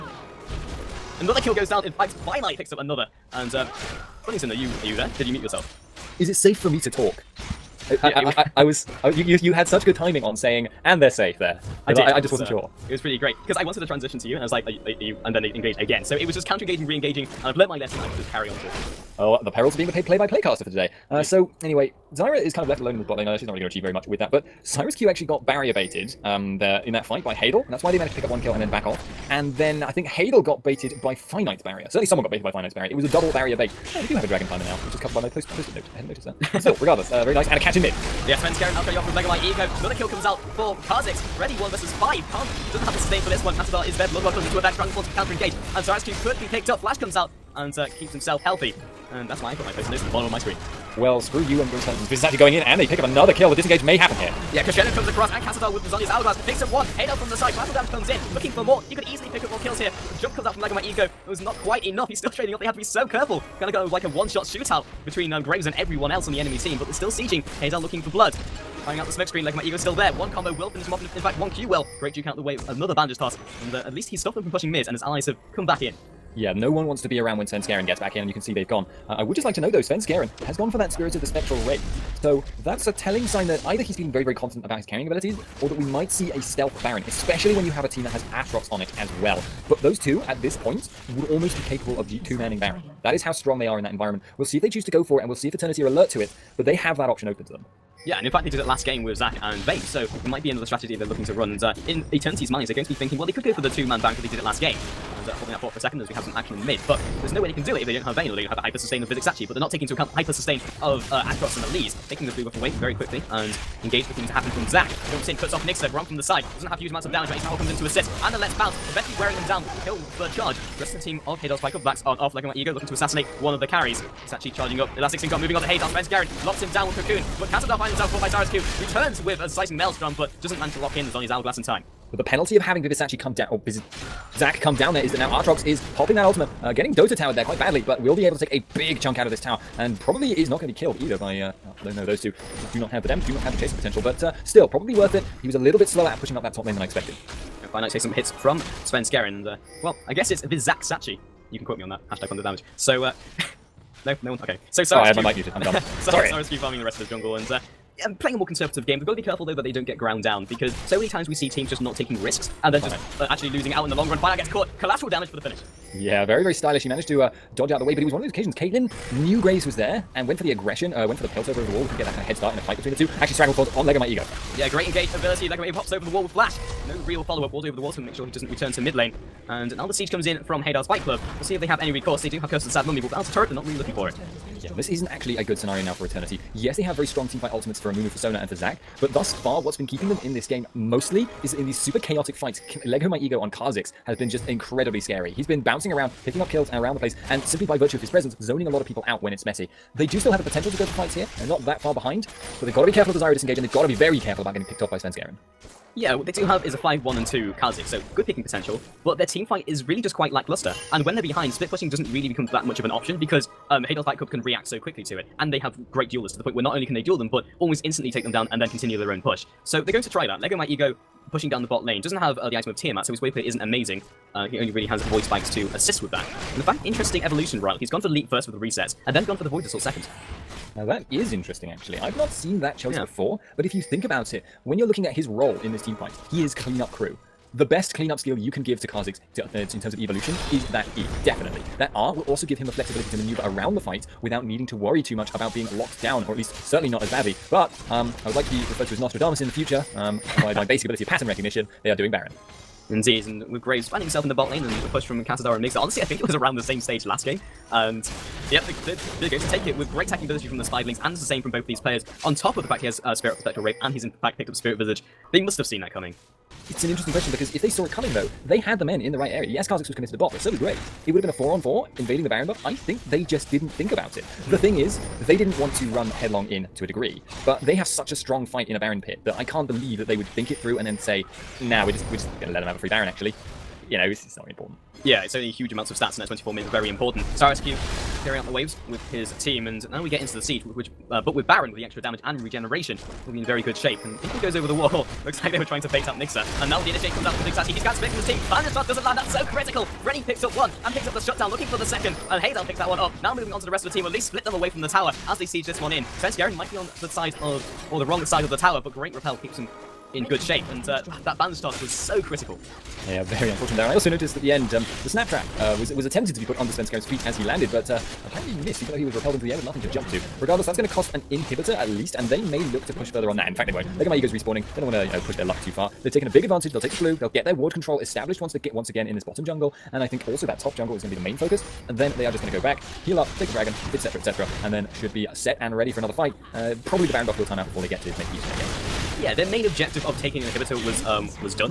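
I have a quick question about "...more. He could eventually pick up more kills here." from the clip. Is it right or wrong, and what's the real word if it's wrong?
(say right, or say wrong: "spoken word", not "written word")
wrong: "easily", not "eventually".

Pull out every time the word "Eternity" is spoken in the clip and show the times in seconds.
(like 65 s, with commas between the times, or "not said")
95 s, 102 s, 186 s.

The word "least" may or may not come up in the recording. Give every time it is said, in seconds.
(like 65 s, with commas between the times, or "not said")
73 s, 246 s, 304 s, 321 s.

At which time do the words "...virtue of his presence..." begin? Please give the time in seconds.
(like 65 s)
197 s.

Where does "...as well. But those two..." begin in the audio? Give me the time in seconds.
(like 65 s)
88 s.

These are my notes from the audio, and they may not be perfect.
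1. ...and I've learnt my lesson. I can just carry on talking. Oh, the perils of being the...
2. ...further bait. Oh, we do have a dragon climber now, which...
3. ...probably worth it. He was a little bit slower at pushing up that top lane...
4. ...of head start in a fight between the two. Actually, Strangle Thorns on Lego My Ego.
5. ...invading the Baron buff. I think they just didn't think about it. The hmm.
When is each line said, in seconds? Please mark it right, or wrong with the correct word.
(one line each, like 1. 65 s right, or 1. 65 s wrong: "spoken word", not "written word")
1. 17 s right
2. 33 s wrong: "barrier", not "further"
3. 144 s right
4. 172 s right
5. 271 s right.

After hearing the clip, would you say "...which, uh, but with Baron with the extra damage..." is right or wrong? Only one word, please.
right.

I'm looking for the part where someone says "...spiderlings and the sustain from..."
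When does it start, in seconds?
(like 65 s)
260 s.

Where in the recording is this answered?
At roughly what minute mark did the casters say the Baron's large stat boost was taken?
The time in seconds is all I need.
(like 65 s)
286 s.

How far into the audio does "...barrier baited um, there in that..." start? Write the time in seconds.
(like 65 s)
25 s.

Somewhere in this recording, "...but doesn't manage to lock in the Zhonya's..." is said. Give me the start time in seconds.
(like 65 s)
130 s.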